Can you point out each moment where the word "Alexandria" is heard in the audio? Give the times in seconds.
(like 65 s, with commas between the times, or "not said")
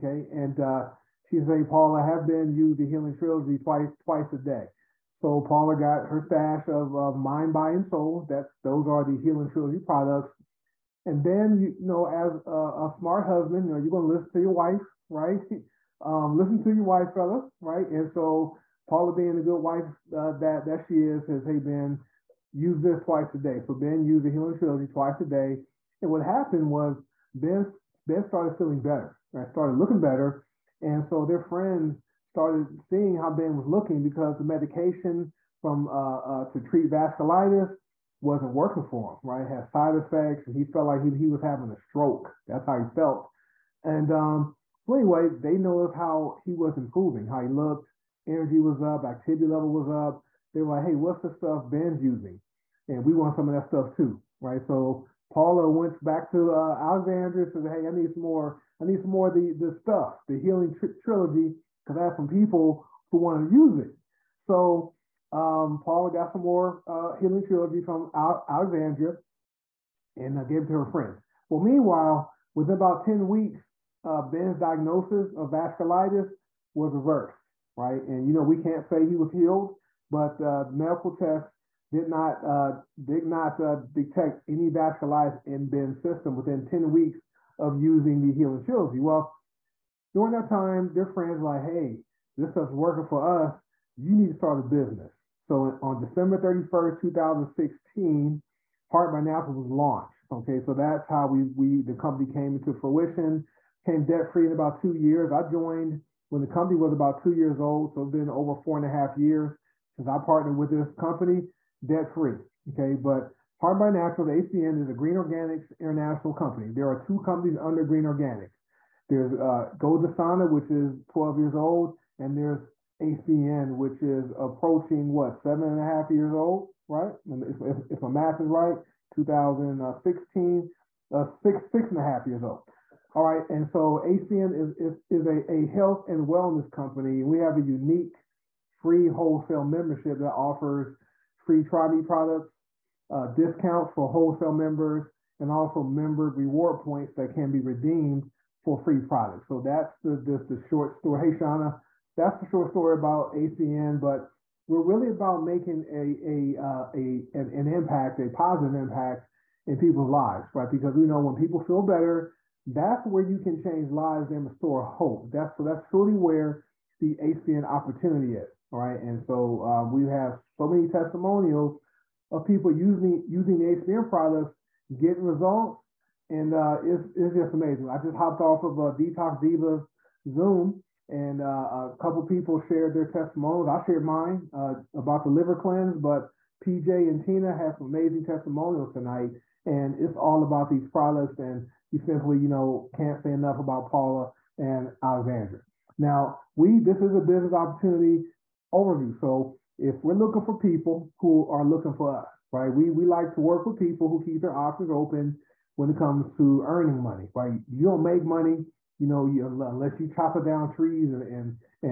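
56 s, 68 s, 195 s.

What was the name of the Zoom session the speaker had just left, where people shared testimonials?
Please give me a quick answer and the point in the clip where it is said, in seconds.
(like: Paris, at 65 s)
Detox Divas, at 178 s.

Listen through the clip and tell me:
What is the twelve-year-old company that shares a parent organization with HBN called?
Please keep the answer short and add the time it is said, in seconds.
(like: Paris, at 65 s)
Gold, at 119 s.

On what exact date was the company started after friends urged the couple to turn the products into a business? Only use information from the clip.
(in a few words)
December 31, 2016.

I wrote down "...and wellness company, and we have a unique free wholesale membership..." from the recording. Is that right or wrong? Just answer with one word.
right.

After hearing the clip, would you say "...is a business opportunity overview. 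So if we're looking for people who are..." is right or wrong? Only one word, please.
right.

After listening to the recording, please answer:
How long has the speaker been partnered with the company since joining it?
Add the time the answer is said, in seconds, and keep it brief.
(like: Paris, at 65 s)
4 and a half years, at 108 s.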